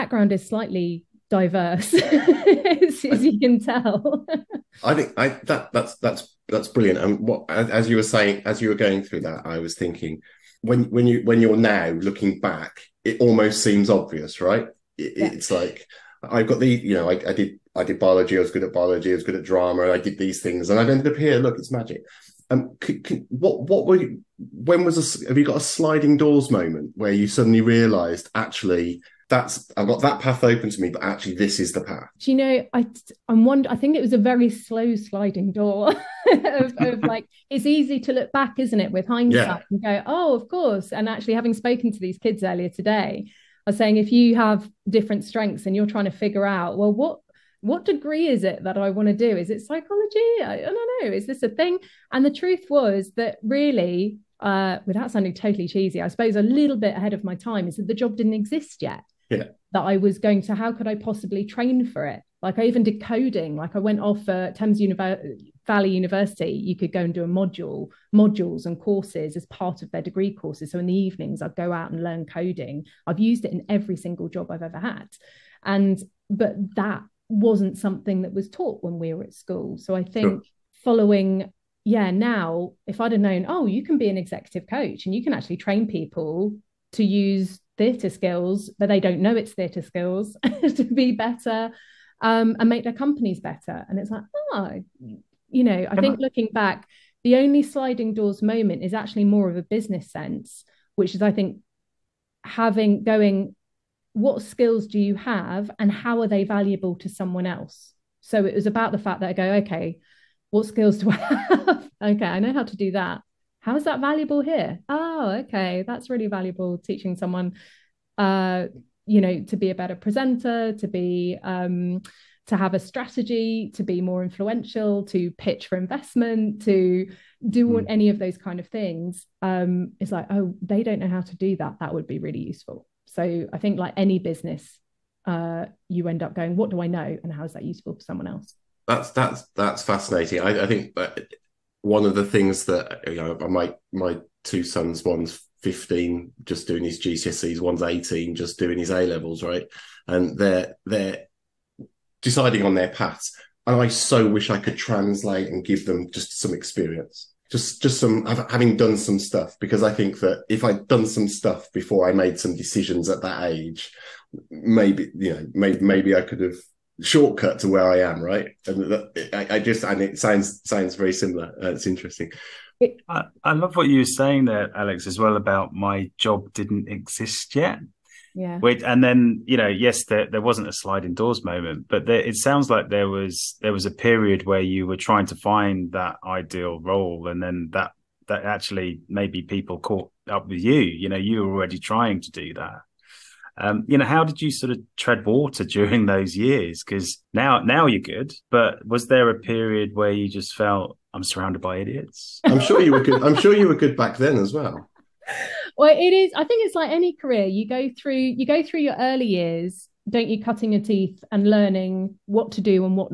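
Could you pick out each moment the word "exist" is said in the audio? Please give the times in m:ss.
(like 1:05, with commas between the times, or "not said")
0:58, 2:56.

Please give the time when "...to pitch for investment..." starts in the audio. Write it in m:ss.
2:05.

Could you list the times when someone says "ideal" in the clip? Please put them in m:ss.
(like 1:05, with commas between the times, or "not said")
3:06.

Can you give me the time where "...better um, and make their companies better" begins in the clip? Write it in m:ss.
1:31.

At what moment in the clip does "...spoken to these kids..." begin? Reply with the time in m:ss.
0:41.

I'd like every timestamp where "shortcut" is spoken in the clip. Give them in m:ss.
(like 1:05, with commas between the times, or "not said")
2:47.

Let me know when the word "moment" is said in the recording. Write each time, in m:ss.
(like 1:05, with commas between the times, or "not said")
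0:26, 1:38, 3:01.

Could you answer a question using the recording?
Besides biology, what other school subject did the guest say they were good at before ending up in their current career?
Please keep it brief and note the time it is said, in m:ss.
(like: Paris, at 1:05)
Drama, at 0:19.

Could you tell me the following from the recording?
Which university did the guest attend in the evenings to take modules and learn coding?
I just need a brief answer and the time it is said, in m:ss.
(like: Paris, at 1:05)
Thames Valley University, at 1:04.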